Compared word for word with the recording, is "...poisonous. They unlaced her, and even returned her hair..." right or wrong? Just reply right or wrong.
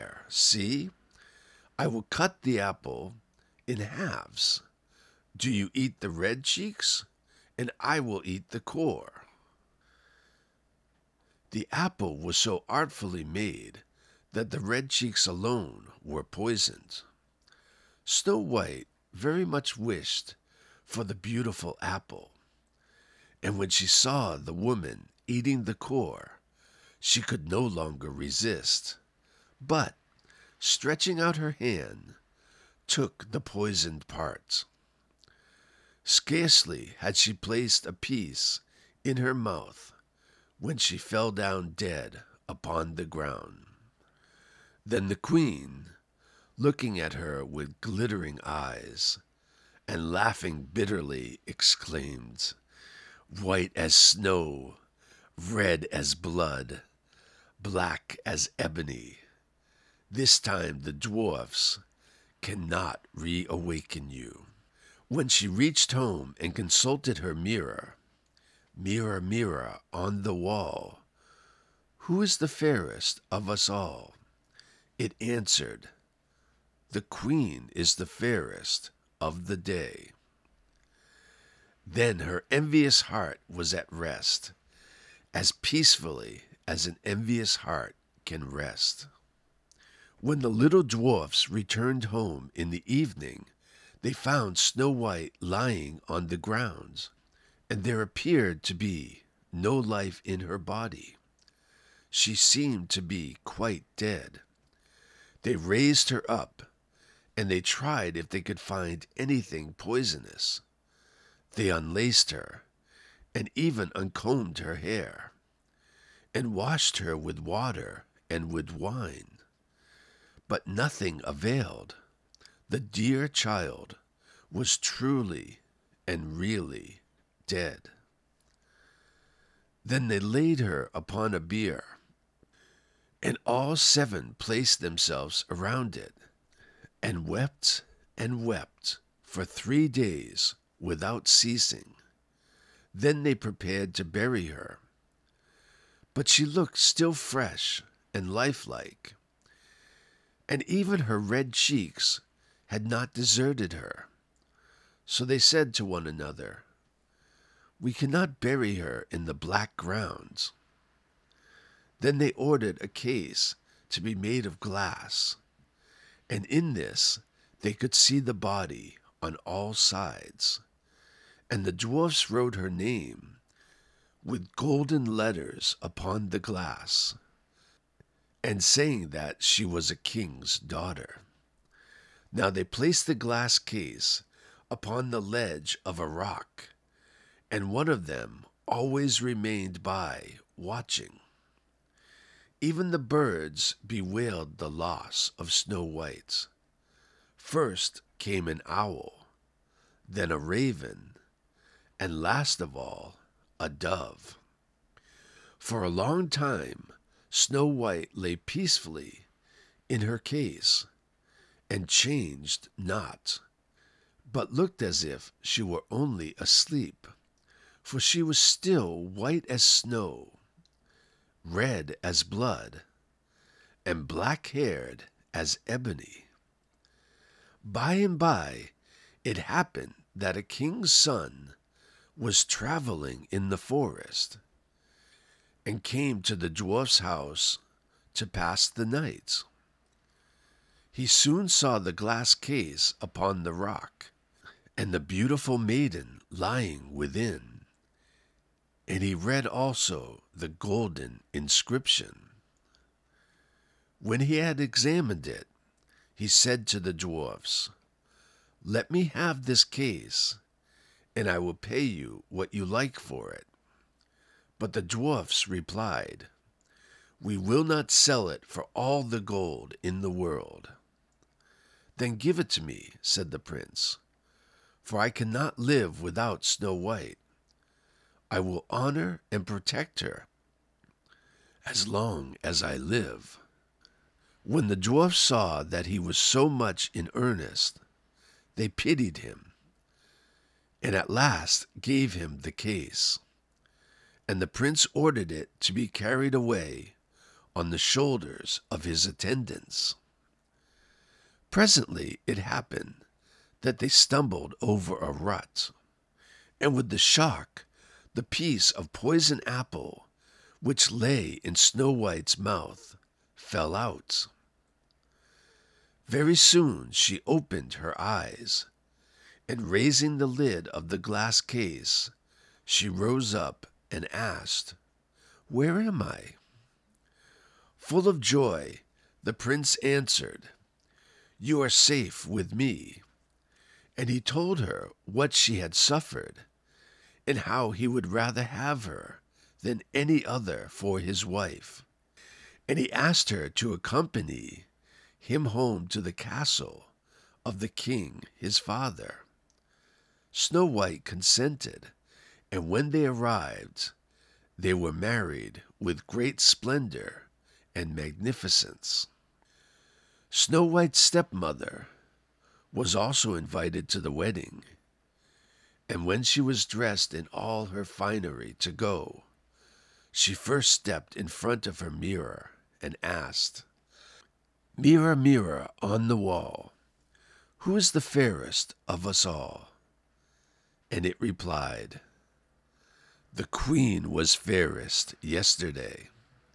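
wrong.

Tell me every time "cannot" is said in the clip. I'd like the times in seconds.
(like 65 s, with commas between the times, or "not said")
62 s, 157 s, 275 s.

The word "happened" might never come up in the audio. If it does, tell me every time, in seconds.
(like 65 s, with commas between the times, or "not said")
229 s, 302 s.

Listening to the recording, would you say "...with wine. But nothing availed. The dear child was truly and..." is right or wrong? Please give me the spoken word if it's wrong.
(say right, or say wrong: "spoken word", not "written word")
right.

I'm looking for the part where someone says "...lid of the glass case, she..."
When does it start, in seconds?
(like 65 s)
320 s.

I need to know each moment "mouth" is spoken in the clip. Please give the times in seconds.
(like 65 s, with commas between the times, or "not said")
39 s, 312 s.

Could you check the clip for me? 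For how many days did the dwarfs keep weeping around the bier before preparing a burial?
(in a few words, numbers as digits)
3.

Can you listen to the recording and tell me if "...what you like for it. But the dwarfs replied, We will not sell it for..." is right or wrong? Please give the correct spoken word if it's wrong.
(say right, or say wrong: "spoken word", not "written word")
right.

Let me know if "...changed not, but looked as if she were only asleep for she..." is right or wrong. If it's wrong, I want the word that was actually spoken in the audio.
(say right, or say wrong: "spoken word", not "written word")
right.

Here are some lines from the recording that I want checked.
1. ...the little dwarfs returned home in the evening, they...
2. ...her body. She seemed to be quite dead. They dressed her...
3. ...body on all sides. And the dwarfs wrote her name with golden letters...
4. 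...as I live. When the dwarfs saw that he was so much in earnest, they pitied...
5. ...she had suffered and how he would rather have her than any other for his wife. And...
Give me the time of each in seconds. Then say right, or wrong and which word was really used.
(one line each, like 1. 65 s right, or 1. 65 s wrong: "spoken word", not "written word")
1. 90 s right
2. 100 s wrong: "raised", not "dressed"
3. 168 s right
4. 282 s right
5. 335 s right.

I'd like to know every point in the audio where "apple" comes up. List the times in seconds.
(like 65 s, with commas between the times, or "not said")
2 s, 11 s, 21 s, 309 s.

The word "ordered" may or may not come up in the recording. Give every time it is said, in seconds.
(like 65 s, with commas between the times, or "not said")
162 s, 294 s.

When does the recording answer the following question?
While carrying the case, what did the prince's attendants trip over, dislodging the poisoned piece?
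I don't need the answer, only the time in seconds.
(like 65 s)
304 s.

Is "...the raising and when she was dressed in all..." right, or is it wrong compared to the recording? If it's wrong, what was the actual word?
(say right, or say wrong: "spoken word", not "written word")
wrong: "wedding", not "raising".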